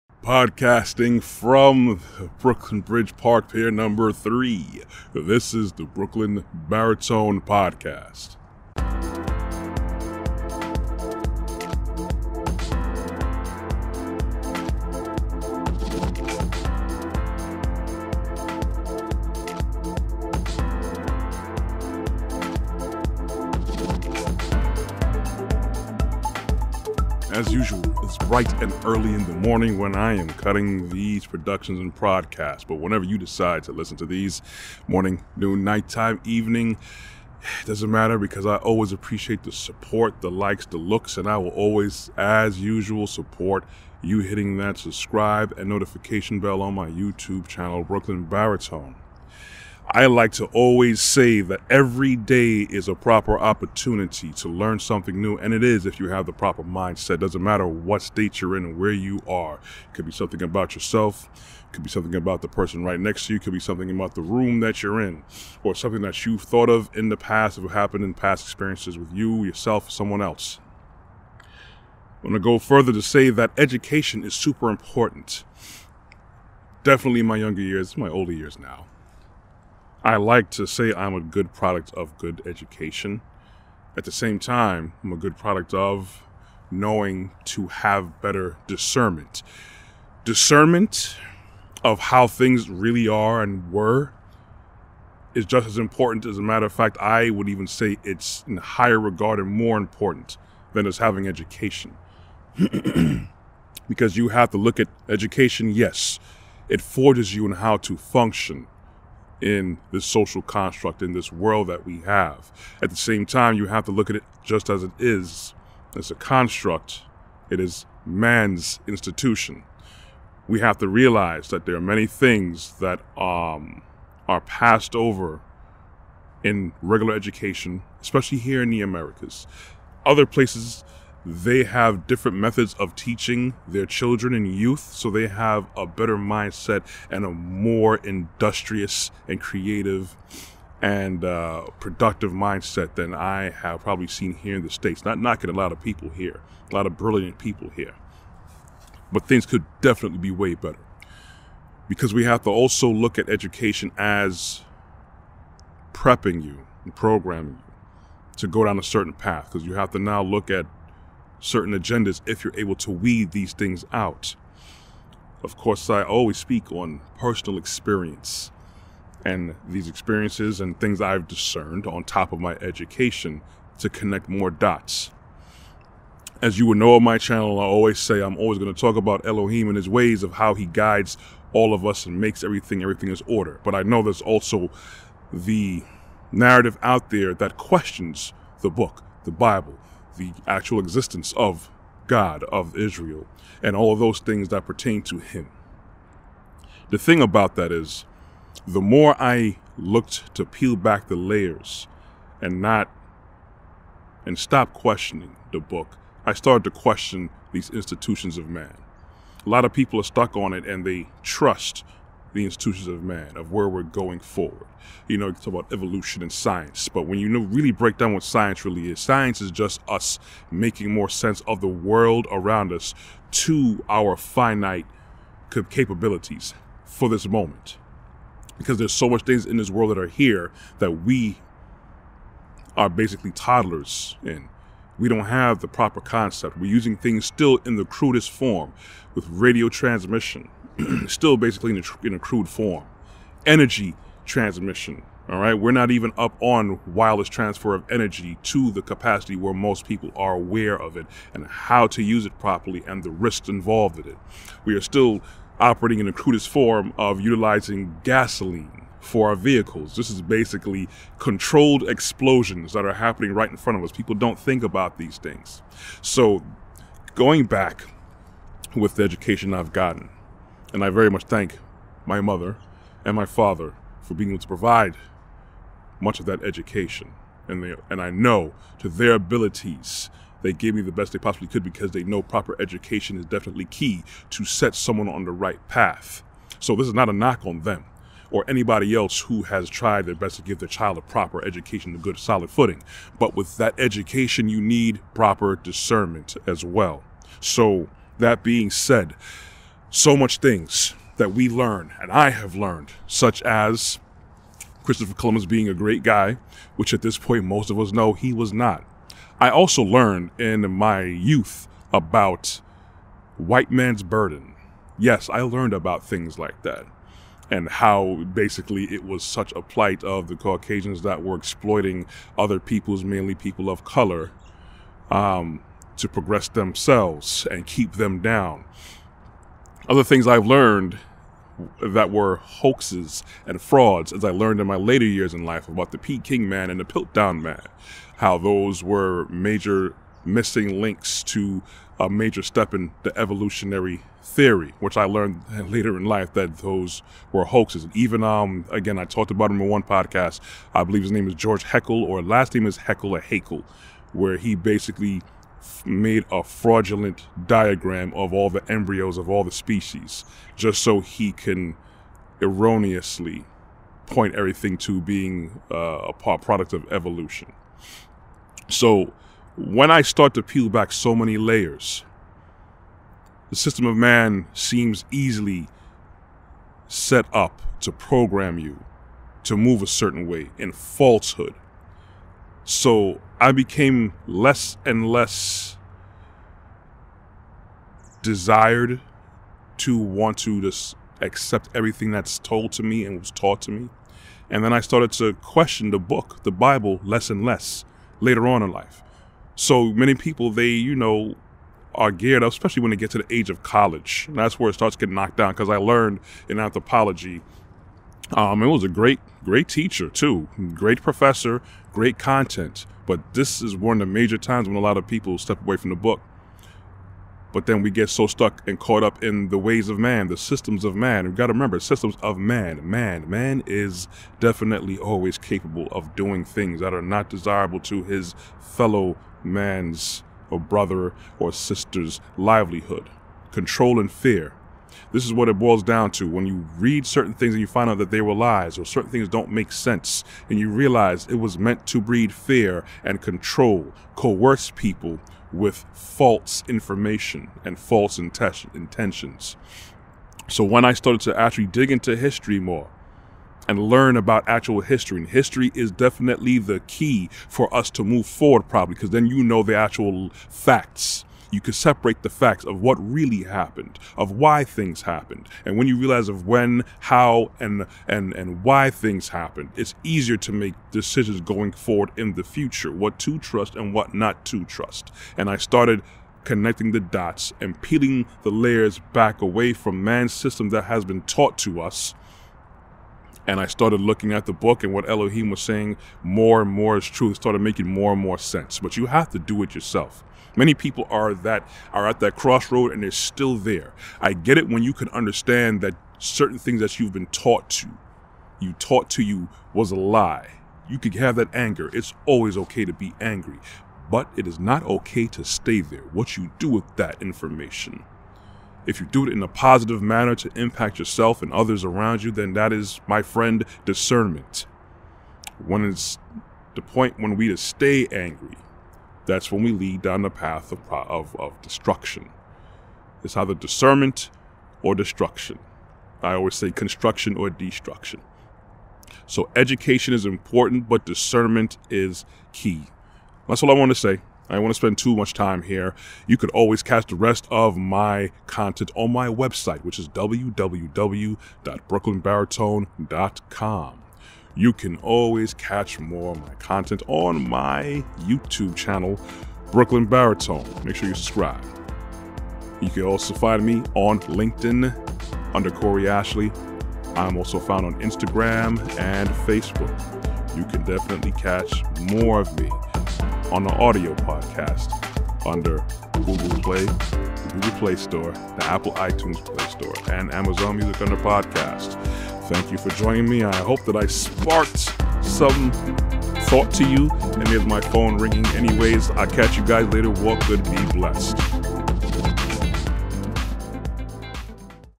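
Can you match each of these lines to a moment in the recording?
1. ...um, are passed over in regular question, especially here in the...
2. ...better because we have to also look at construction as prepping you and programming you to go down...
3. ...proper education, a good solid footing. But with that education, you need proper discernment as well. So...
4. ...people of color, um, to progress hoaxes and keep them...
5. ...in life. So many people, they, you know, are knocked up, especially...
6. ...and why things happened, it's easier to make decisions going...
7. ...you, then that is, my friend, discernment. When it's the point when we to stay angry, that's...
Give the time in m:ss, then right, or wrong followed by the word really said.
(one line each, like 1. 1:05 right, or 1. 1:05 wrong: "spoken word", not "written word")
1. 2:03 wrong: "education", not "question"
2. 2:30 wrong: "education", not "construction"
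3. 4:51 right
4. 5:23 wrong: "themselves", not "hoaxes"
5. 6:38 wrong: "geared", not "knocked"
6. 7:48 right
7. 8:32 right.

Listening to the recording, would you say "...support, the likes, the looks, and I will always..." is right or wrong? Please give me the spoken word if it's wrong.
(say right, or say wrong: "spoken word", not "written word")
right.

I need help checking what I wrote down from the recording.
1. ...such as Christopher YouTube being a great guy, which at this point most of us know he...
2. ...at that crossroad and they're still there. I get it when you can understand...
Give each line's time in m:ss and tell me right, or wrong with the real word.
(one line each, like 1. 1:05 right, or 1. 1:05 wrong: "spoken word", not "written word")
1. 5:03 wrong: "Columbus", not "YouTube"
2. 8:12 right.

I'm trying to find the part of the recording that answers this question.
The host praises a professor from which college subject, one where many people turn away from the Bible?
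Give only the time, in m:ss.
6:46.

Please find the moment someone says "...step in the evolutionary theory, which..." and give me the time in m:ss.
5:42.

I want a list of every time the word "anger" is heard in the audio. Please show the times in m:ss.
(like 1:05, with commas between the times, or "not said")
8:21.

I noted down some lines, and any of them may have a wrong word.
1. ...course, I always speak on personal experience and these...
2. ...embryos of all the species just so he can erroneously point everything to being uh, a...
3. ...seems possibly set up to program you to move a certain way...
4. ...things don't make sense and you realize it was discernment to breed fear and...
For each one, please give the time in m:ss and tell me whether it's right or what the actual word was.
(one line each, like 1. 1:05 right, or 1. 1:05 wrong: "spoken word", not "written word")
1. 2:45 right
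2. 5:58 right
3. 6:14 wrong: "easily", not "possibly"
4. 7:19 wrong: "meant", not "discernment".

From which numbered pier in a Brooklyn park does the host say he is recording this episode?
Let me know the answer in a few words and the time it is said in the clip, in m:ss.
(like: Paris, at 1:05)
Pier 3, at 0:03.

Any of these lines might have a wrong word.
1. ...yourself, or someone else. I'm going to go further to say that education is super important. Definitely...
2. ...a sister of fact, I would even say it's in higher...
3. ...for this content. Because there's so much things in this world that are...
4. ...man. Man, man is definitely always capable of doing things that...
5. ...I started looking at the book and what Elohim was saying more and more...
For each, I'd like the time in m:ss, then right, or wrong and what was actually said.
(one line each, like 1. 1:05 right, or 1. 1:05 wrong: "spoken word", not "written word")
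1. 1:09 right
2. 1:36 wrong: "matter", not "sister"
3. 3:46 wrong: "moment", not "content"
4. 7:02 right
5. 8:03 right.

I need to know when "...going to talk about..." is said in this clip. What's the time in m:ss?
2:58.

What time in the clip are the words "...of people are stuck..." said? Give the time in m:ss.
3:29.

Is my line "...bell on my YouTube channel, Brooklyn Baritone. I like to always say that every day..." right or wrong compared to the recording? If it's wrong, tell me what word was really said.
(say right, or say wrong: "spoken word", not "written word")
right.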